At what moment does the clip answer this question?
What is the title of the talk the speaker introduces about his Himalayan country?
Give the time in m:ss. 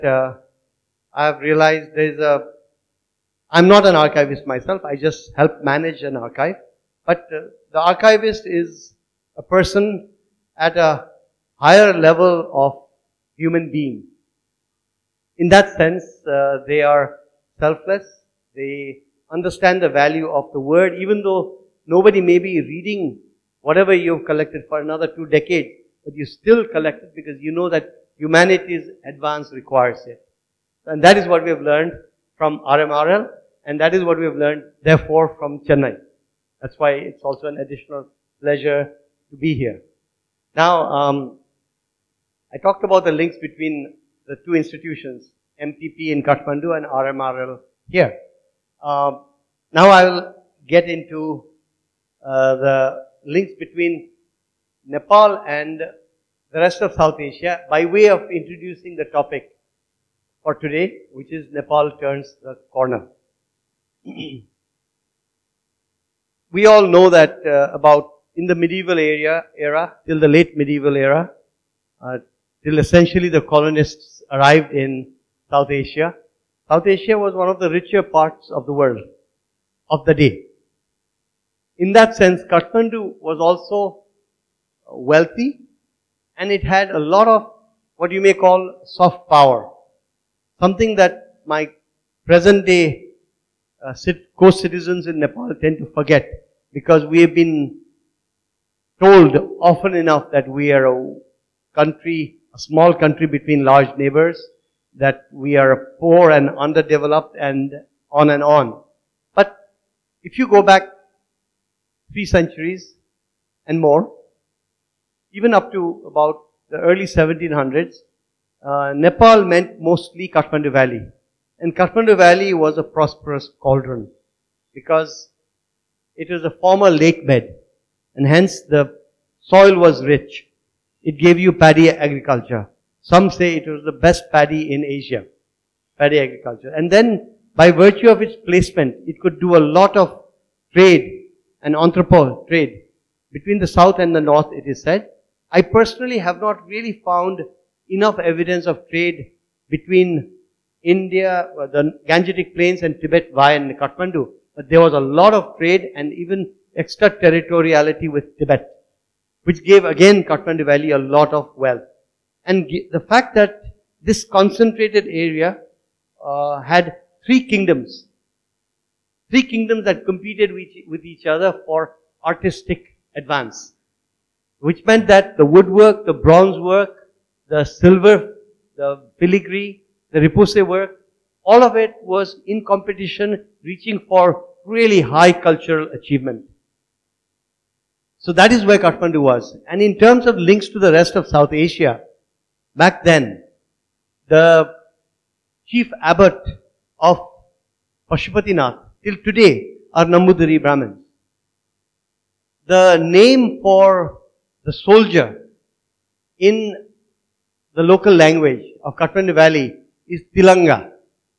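1:01.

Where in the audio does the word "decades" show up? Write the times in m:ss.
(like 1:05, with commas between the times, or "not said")
0:25.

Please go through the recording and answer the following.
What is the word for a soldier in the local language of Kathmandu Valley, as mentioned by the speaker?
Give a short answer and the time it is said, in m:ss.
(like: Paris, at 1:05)
Tilanga, at 3:30.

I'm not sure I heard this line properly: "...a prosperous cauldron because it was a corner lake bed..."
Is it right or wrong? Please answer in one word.
wrong.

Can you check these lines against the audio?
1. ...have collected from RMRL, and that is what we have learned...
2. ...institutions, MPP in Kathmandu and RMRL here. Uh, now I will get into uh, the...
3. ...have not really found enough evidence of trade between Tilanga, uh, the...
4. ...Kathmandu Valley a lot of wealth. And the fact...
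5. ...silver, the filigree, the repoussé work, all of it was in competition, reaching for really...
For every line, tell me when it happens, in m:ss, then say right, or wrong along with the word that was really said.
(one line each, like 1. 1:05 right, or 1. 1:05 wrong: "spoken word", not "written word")
1. 0:31 wrong: "learned", not "collected"
2. 0:44 right
3. 2:26 wrong: "India", not "Tilanga"
4. 2:40 right
5. 2:57 right.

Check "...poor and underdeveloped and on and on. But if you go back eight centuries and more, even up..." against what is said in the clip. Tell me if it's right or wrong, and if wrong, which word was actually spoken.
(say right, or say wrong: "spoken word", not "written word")
wrong: "three", not "eight".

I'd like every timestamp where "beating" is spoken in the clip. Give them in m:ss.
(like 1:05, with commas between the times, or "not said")
not said.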